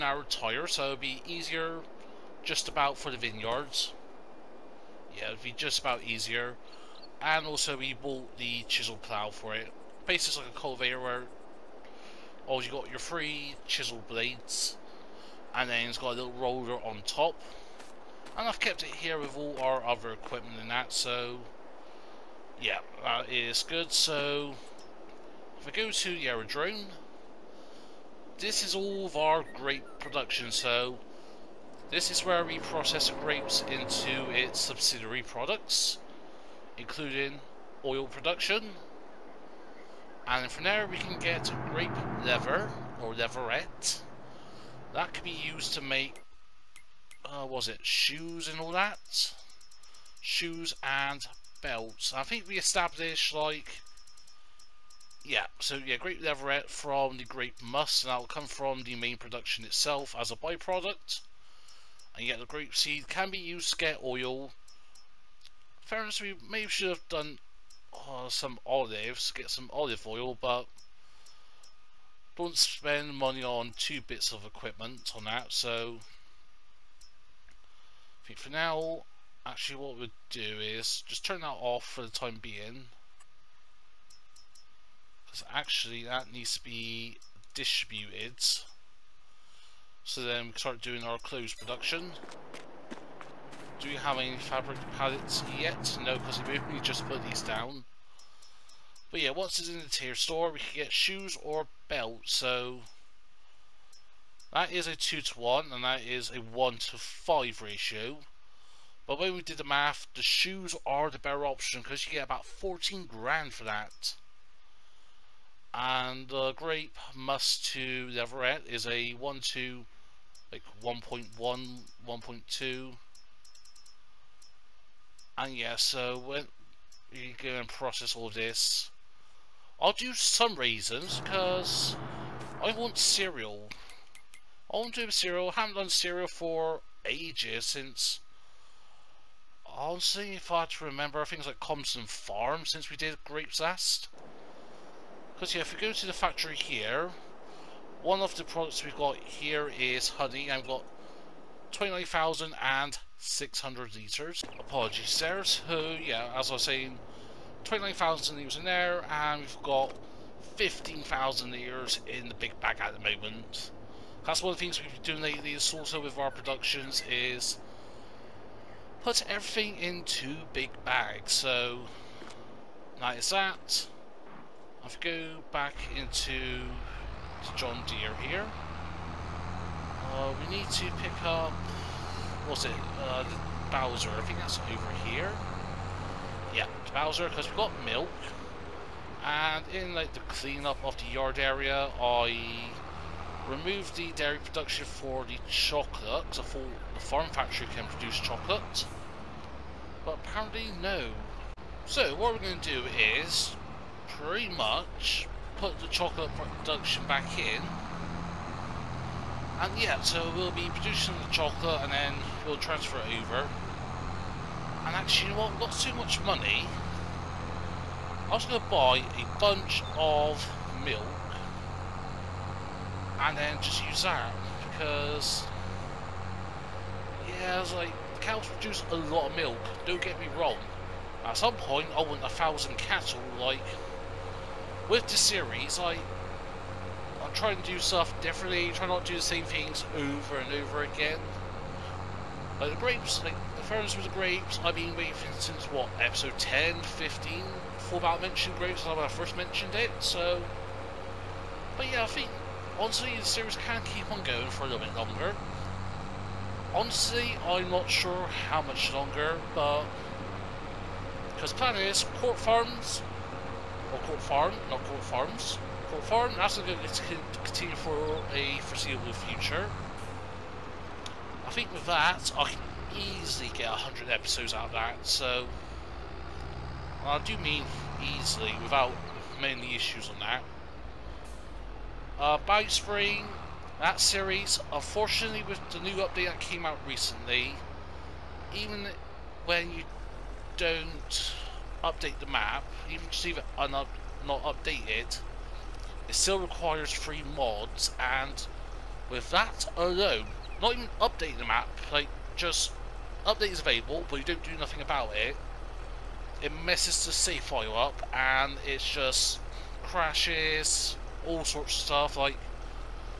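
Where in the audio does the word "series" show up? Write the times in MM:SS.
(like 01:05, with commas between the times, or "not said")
03:55, 04:13, 04:43.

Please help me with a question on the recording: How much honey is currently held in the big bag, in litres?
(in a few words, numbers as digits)
15,000.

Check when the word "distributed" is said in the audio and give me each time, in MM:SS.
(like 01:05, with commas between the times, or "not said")
01:27.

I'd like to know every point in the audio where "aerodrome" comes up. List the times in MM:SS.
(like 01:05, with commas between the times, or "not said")
00:26.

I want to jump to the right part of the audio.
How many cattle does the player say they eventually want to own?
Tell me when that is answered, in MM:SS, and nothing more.
03:52.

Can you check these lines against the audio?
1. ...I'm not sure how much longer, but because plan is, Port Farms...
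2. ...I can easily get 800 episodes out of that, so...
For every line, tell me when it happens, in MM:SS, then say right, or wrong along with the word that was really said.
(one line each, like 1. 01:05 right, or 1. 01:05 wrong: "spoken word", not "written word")
1. 04:17 right
2. 04:32 wrong: "100", not "800".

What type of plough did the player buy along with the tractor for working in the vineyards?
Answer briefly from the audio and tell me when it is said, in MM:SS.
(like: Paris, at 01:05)
chisel plough, at 00:08.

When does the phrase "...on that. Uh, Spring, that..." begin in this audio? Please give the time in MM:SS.
04:40.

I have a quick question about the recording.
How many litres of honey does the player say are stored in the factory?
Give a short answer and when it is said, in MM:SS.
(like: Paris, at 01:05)
29,600, at 02:31.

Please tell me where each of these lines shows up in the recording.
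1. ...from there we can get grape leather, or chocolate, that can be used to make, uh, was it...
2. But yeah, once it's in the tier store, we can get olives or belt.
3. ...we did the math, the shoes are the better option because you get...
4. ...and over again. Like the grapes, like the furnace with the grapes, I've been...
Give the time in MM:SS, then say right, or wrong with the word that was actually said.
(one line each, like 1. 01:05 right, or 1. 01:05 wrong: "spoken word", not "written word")
1. 00:40 wrong: "leatherette", not "chocolate"
2. 01:39 wrong: "shoes", not "olives"
3. 01:49 right
4. 04:00 right.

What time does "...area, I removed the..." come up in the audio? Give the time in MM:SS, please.
03:11.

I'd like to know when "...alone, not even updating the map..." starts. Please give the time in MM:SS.
04:59.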